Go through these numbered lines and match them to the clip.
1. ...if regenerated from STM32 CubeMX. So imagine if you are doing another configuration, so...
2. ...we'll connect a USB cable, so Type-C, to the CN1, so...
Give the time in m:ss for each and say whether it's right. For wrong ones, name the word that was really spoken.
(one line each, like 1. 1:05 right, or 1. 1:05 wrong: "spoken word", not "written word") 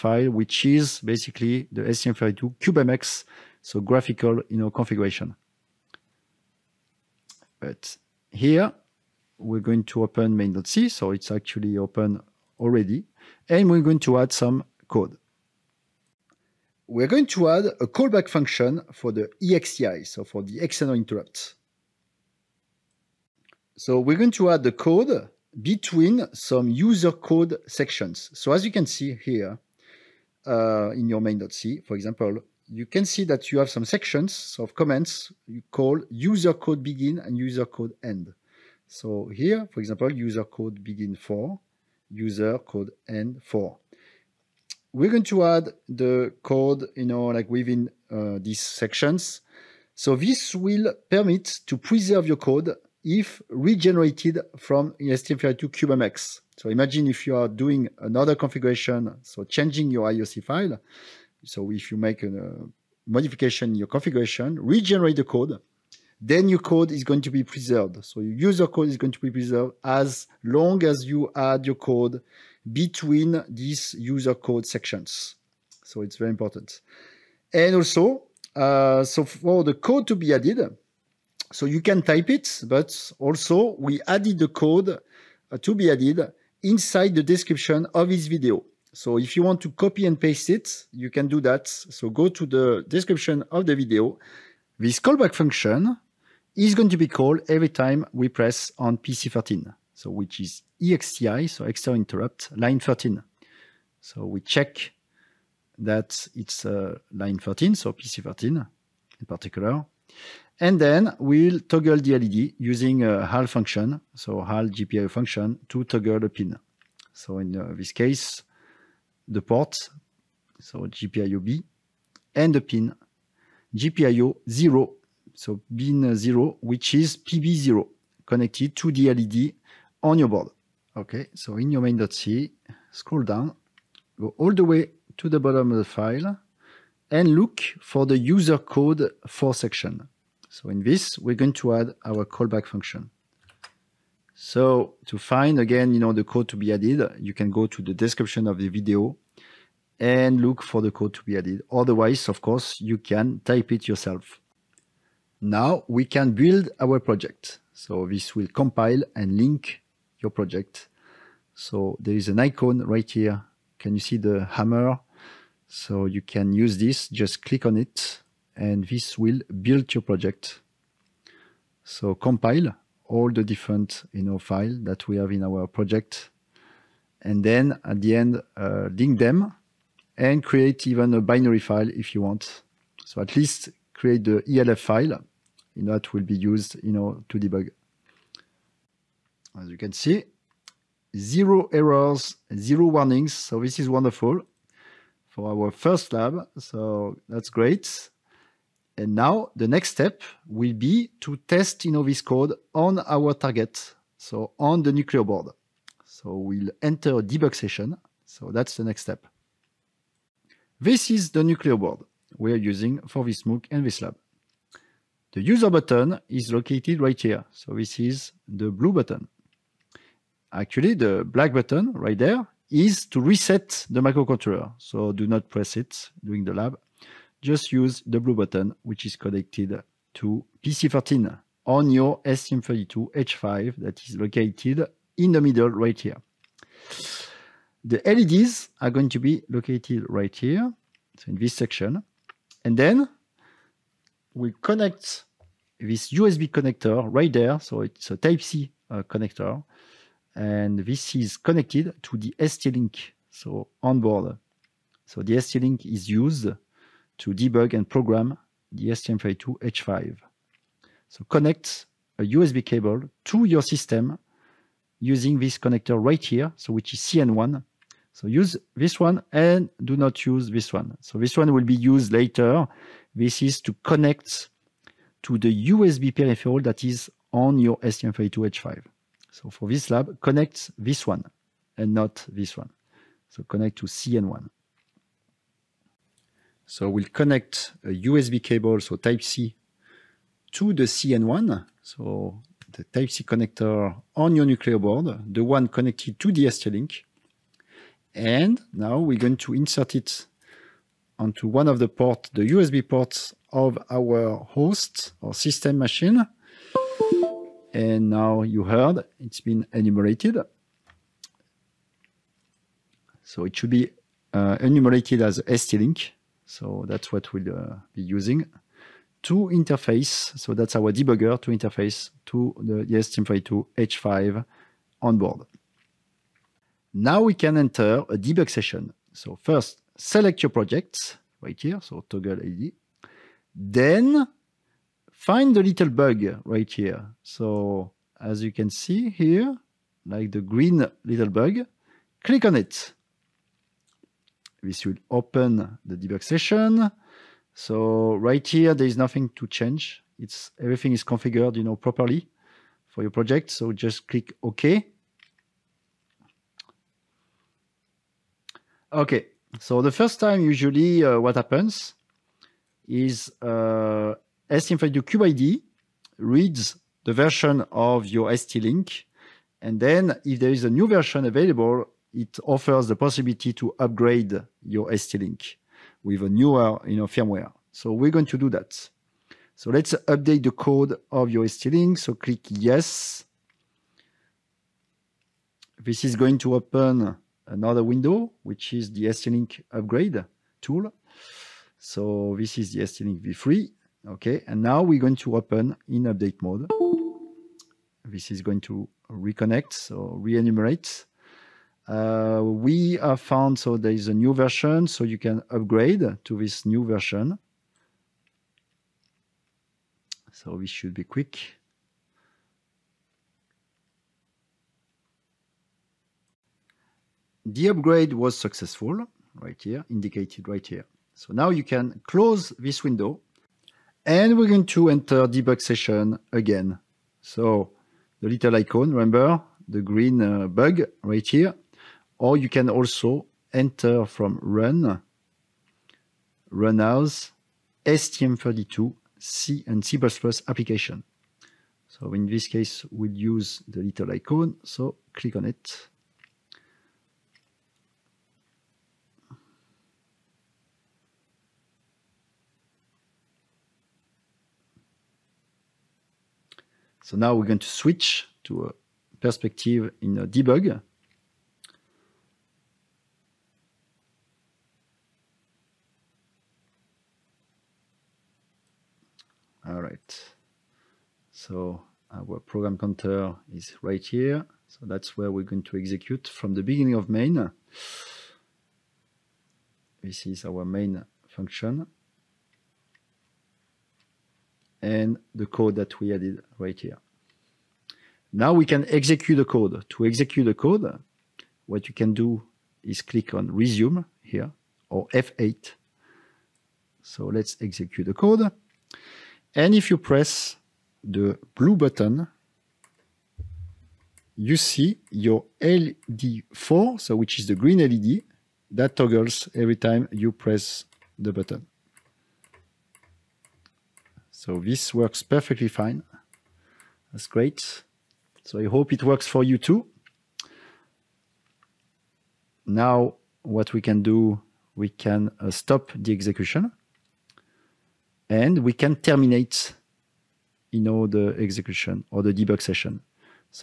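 1. 0:53 right
2. 4:46 right.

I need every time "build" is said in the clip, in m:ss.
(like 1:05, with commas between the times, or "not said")
2:36, 2:49.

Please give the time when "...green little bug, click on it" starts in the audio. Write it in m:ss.
5:40.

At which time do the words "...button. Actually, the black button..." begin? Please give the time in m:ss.
3:38.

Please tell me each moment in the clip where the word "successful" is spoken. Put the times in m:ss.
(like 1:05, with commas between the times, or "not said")
6:58.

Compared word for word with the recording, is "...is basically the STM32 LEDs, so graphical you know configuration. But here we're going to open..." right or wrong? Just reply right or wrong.
wrong.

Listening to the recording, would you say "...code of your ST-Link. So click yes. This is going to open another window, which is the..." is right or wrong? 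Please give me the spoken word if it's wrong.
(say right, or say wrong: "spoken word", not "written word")
right.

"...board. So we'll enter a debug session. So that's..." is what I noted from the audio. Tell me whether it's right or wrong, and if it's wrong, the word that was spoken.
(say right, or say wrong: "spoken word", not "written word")
right.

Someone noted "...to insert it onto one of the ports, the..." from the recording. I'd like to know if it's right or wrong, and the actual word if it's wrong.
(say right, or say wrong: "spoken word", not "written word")
right.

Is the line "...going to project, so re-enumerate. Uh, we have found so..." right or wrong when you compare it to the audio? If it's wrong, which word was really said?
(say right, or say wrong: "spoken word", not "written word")
wrong: "reconnect", not "project".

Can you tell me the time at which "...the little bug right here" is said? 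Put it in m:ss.
5:35.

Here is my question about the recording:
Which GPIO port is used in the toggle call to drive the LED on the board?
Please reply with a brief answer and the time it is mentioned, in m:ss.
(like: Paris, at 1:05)
GPIO B, at 2:00.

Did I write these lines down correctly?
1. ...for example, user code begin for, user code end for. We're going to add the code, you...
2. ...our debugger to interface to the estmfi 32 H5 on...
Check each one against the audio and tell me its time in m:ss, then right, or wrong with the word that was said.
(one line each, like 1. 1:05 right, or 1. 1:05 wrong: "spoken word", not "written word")
1. 0:39 right
2. 5:20 right.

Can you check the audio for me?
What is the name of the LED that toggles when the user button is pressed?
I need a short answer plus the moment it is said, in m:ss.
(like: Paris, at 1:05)
LED4, at 8:25.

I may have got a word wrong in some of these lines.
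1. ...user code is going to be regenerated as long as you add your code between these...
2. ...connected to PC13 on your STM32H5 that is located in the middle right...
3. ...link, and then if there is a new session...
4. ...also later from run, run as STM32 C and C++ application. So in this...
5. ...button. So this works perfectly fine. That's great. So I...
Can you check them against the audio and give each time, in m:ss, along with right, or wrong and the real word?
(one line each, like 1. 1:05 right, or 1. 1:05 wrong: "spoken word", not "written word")
1. 1:08 wrong: "preserved", not "regenerated"
2. 3:49 right
3. 6:08 wrong: "version", not "session"
4. 7:12 wrong: "enter", not "later"
5. 8:31 right.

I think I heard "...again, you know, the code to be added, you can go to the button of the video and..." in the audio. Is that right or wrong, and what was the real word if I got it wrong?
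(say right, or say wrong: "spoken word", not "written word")
wrong: "description", not "button".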